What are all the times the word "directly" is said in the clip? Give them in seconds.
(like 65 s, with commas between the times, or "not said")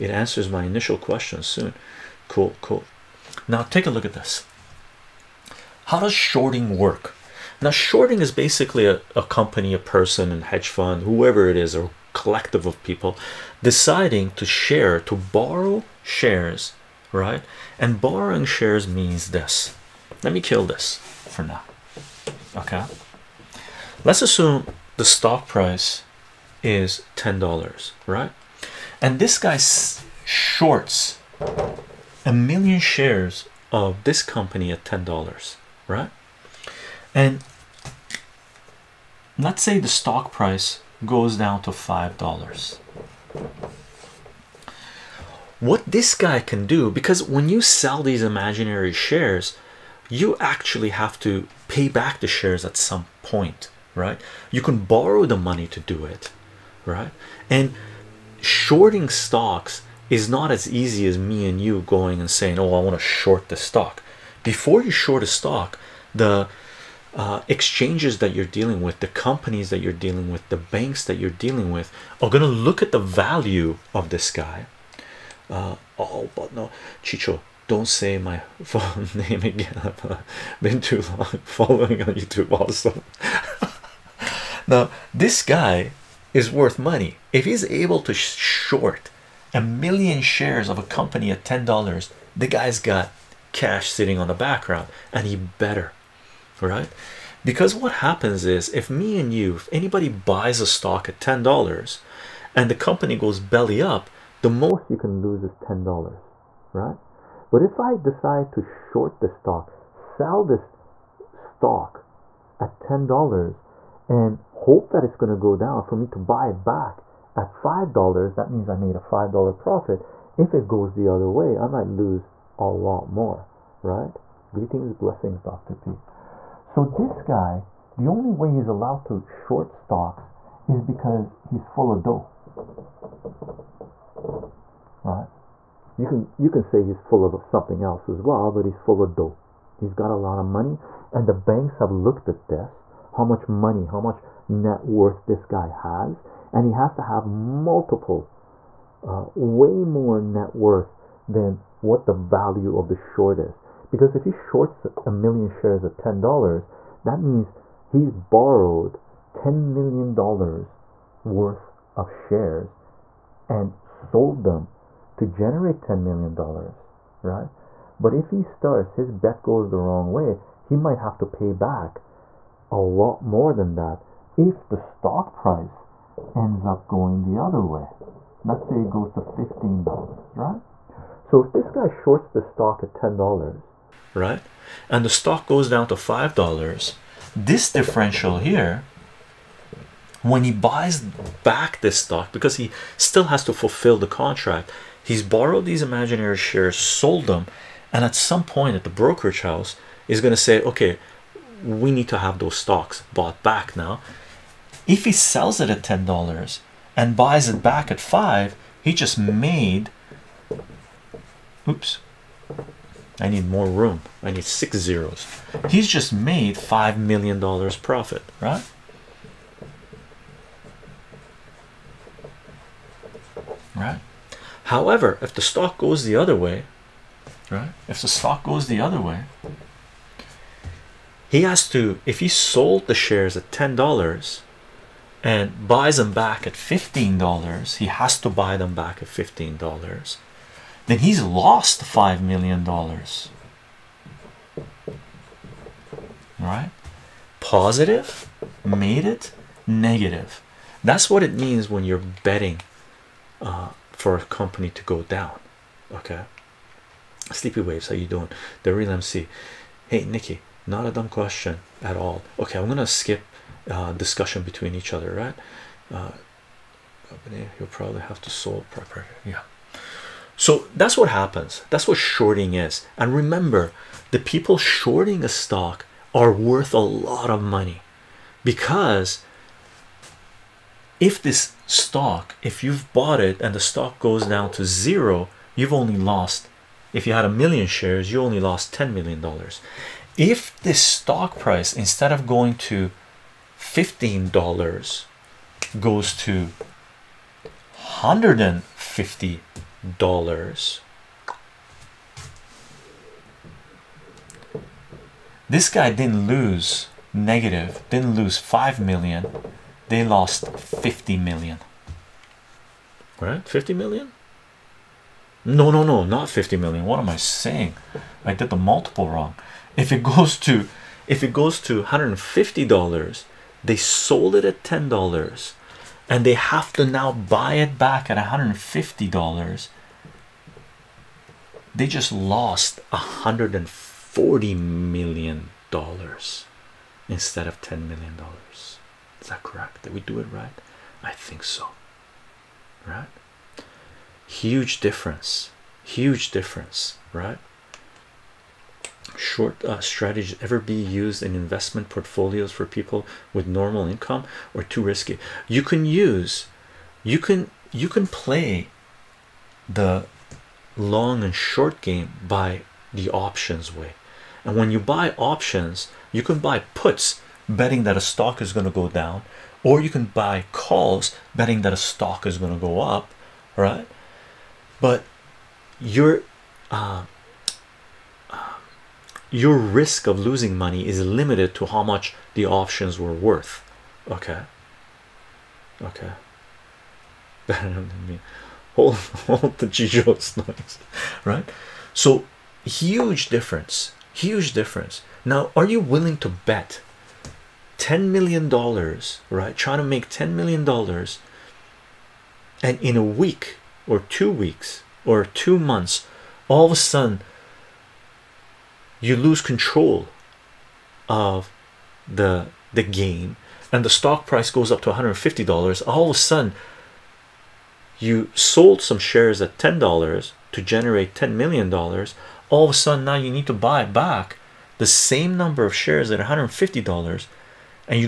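not said.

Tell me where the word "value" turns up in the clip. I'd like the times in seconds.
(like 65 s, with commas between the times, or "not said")
72 s, 152 s.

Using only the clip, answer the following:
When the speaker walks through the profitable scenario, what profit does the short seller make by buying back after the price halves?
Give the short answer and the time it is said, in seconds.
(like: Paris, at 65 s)
$5 million, at 216 s.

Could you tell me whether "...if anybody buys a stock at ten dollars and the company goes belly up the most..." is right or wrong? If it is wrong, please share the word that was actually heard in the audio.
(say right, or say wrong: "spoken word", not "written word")
right.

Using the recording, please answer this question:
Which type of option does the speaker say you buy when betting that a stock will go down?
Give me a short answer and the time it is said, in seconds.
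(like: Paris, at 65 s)
puts, at 366 s.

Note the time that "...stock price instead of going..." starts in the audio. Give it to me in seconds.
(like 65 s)
290 s.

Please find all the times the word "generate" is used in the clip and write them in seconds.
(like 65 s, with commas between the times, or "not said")
165 s, 420 s.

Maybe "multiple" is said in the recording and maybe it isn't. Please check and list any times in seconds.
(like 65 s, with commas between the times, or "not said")
147 s, 318 s.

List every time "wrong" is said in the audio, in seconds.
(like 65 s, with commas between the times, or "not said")
169 s, 319 s.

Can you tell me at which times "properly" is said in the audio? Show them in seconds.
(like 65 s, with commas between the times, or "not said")
268 s.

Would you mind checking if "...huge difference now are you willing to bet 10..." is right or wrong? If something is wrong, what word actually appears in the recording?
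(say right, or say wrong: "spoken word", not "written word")
right.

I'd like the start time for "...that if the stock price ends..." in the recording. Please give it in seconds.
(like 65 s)
173 s.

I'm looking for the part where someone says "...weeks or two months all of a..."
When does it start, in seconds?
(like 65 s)
404 s.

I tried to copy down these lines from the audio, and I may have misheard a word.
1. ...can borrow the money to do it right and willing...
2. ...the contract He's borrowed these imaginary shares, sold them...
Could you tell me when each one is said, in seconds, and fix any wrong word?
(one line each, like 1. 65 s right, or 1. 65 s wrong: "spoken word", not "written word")
1. 54 s wrong: "shorting", not "willing"
2. 193 s right.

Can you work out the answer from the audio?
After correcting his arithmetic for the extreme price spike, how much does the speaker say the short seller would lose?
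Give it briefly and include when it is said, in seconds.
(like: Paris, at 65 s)
$140 million, at 332 s.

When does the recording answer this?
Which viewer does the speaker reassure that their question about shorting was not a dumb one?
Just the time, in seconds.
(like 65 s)
260 s.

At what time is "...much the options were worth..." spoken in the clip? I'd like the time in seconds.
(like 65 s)
381 s.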